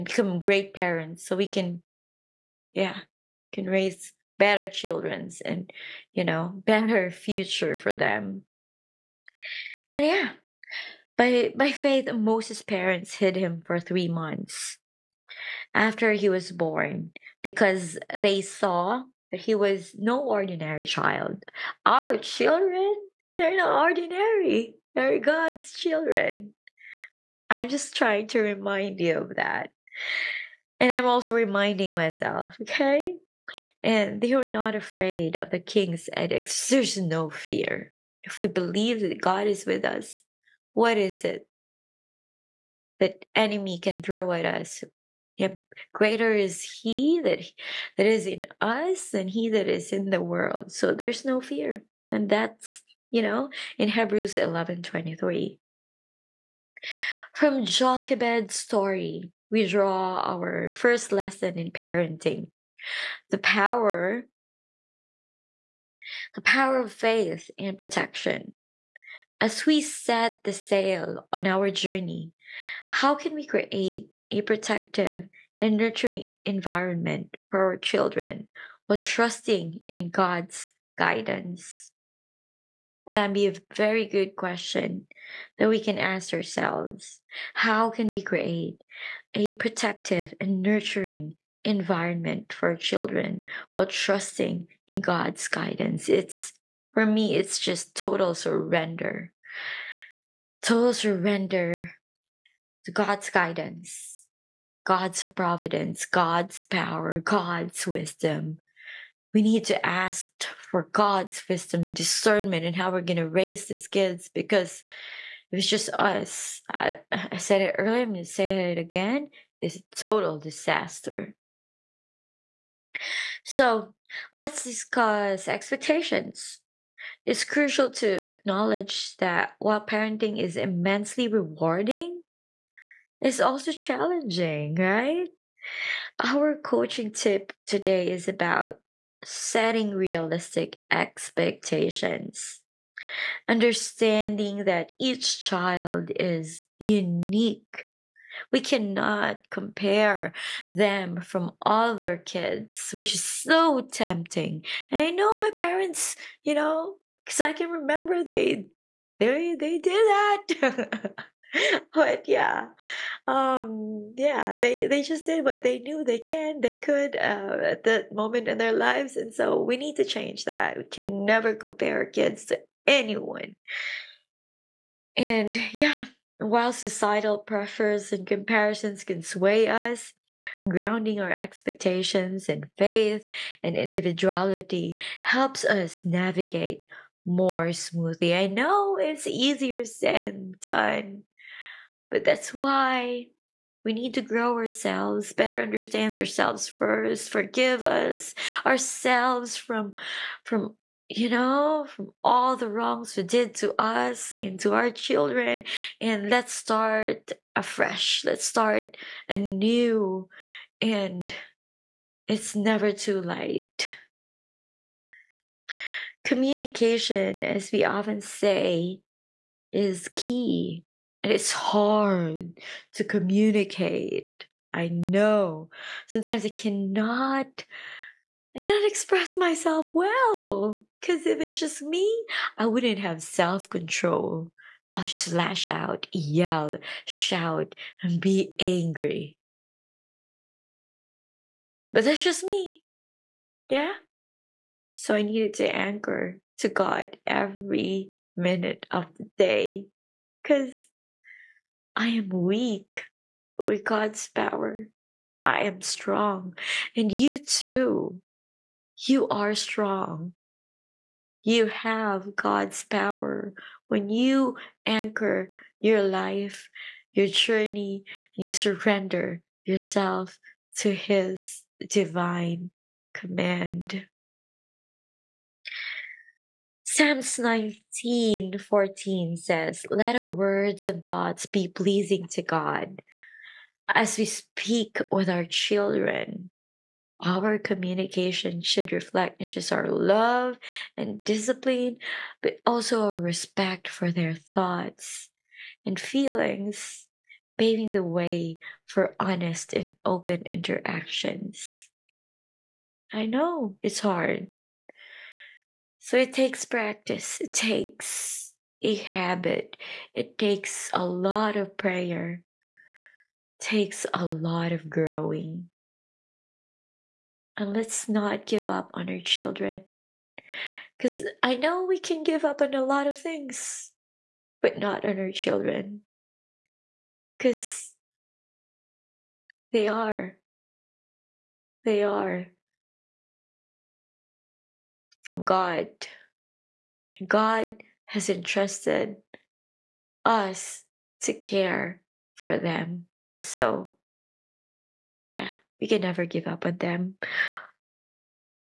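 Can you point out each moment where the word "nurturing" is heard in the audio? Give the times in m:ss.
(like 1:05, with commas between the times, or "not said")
1:15, 1:30.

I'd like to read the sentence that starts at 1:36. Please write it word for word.
It's for me, it's just total surrender.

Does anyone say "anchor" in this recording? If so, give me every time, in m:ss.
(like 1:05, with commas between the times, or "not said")
4:05, 4:24.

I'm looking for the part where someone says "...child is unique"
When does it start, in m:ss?
2:25.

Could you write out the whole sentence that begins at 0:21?
Our children, they're not ordinary, they're God's children.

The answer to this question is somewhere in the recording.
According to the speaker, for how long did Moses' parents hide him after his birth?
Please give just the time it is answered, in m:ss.
0:13.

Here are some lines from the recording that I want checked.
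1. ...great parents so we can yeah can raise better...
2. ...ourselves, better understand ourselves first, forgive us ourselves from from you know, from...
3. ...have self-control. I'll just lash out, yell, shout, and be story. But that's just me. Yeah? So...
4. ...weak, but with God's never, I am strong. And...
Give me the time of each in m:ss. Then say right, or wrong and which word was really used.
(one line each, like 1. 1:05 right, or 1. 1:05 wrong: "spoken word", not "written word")
1. 0:00 right
2. 3:14 right
3. 3:52 wrong: "angry", not "story"
4. 4:12 wrong: "power", not "never".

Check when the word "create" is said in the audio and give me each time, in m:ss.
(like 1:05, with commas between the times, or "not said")
1:13, 1:28.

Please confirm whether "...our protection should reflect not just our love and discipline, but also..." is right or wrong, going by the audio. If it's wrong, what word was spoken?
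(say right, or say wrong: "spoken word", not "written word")
wrong: "communication", not "protection".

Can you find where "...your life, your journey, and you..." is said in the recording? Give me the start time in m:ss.
4:25.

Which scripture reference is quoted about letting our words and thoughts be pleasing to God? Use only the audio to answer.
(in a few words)
Psalms 19:14.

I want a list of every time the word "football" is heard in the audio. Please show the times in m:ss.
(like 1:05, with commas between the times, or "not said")
not said.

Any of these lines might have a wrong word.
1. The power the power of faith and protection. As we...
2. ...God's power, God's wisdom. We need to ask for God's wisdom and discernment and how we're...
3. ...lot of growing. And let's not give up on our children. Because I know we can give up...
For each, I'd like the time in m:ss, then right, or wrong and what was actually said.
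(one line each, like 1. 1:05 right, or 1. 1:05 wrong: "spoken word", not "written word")
1. 1:03 right
2. 1:46 right
3. 5:14 right.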